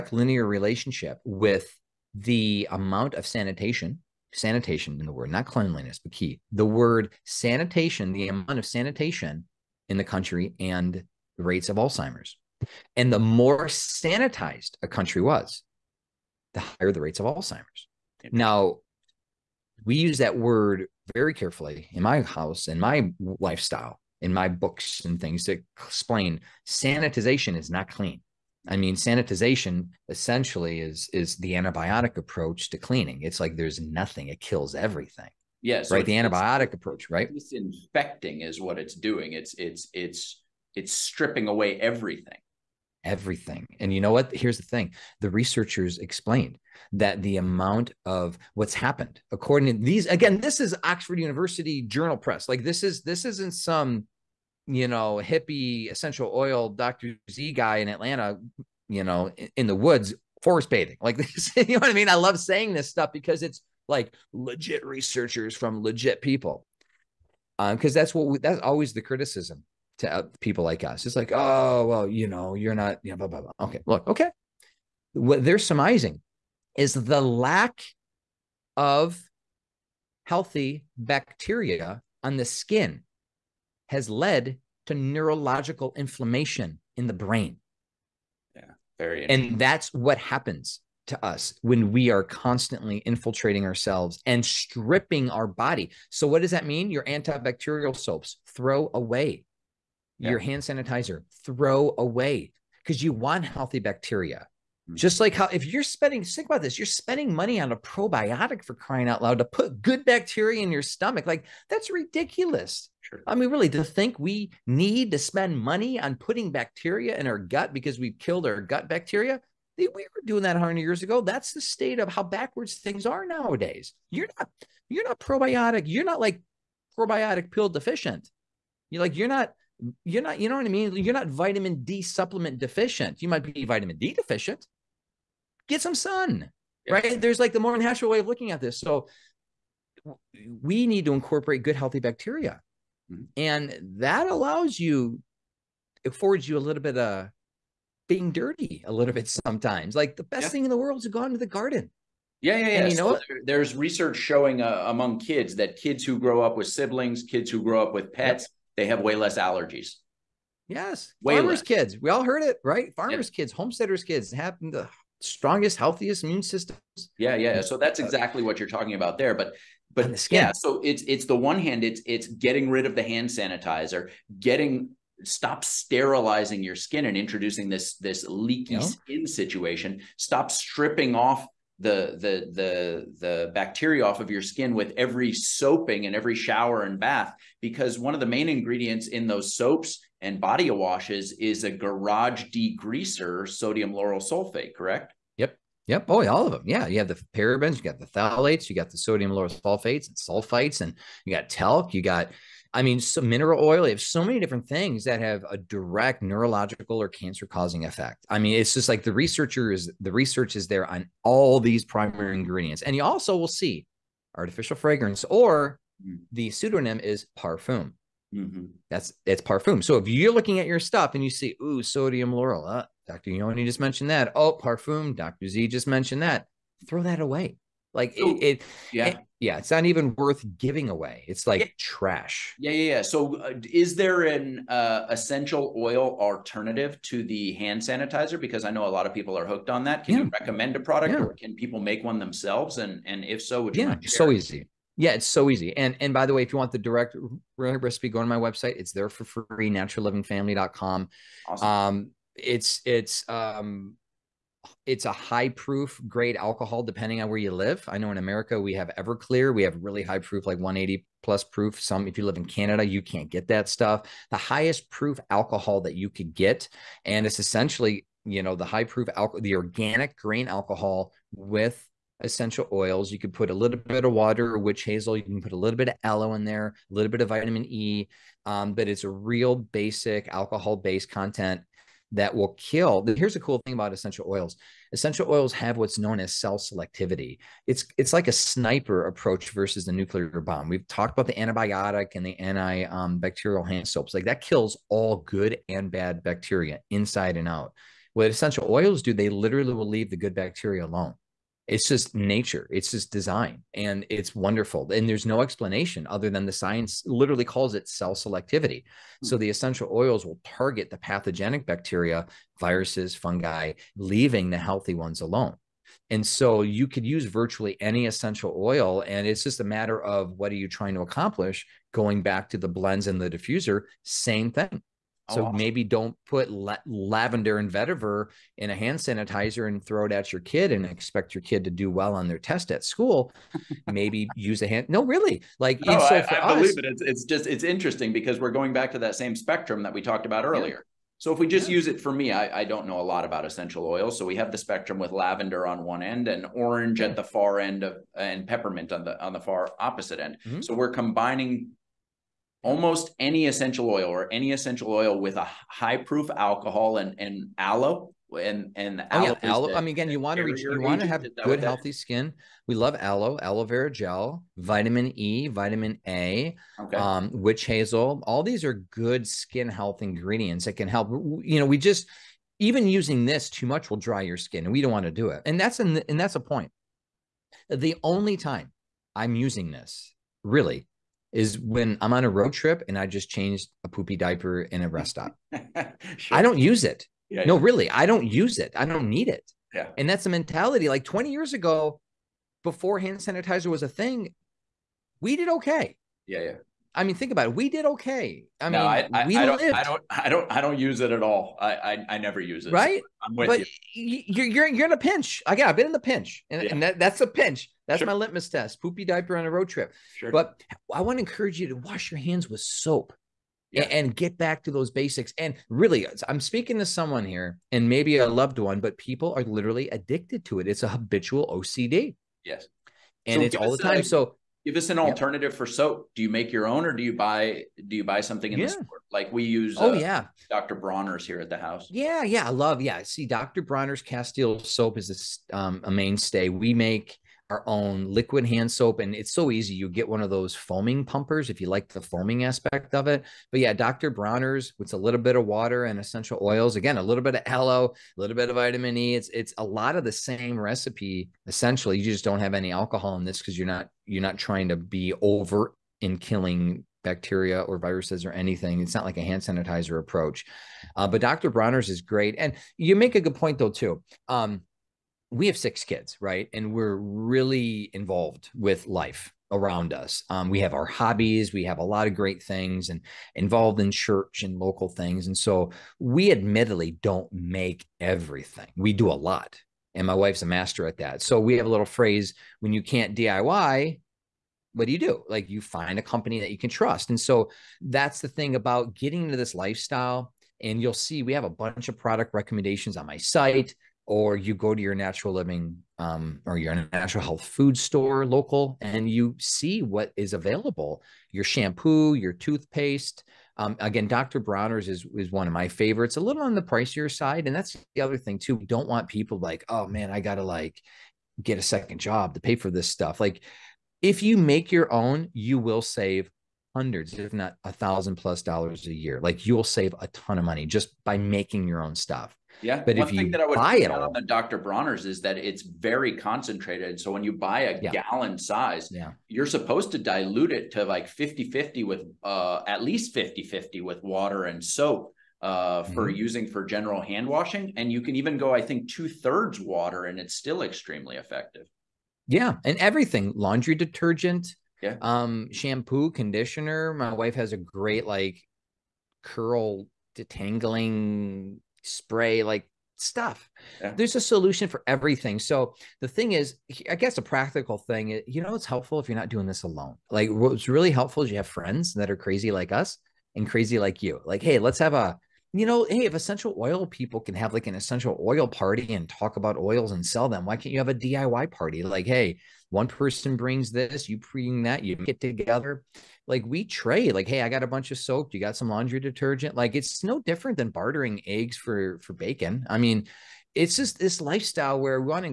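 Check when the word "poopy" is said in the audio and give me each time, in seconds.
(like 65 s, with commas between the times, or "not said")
383 s, 408 s.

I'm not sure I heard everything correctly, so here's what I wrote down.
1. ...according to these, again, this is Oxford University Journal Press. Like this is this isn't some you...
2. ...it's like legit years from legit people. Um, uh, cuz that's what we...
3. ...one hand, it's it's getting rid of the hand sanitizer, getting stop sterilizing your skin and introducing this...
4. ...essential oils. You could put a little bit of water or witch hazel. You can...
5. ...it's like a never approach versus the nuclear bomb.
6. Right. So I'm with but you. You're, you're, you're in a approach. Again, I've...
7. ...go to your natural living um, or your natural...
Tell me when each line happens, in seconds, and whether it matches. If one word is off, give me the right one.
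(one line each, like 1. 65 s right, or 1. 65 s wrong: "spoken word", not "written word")
1. 49 s right
2. 63 s wrong: "researchers", not "years"
3. 171 s right
4. 272 s right
5. 287 s wrong: "sniper", not "never"
6. 402 s wrong: "pinch", not "approach"
7. 494 s right.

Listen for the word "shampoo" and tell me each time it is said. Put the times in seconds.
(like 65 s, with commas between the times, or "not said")
501 s, 545 s.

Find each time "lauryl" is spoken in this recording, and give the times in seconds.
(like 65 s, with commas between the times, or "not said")
193 s, 199 s, 222 s.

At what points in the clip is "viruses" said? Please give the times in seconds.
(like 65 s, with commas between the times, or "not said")
312 s, 457 s.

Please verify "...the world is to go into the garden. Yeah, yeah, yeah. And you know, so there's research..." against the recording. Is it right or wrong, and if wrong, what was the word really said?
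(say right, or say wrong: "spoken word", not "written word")
right.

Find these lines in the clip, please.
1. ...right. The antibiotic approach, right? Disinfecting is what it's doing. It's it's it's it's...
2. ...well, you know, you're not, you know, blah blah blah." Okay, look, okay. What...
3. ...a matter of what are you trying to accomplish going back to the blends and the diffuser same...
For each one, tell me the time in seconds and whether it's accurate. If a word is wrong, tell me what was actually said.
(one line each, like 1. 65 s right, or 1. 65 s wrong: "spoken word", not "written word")
1. 35 s right
2. 71 s right
3. 319 s right.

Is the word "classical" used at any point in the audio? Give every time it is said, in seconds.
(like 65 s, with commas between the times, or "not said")
not said.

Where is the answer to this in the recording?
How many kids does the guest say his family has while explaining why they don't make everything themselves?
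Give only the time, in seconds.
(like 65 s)
465 s.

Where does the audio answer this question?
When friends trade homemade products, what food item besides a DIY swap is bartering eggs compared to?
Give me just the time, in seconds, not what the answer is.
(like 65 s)
582 s.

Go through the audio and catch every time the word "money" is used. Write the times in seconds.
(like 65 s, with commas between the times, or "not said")
107 s, 115 s, 520 s.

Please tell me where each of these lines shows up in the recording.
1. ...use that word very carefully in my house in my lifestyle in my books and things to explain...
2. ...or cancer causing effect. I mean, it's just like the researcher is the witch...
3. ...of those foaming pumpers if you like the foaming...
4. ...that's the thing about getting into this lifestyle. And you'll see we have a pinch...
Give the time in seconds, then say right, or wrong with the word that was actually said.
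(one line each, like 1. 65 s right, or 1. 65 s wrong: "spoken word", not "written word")
1. 19 s right
2. 207 s wrong: "research", not "witch"
3. 440 s right
4. 487 s wrong: "bunch", not "pinch".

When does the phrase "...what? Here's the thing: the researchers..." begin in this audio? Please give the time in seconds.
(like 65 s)
44 s.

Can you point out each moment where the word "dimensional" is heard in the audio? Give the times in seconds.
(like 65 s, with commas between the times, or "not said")
not said.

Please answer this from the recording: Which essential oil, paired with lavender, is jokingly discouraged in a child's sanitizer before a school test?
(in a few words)
vetiver.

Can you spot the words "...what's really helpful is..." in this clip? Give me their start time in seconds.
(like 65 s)
560 s.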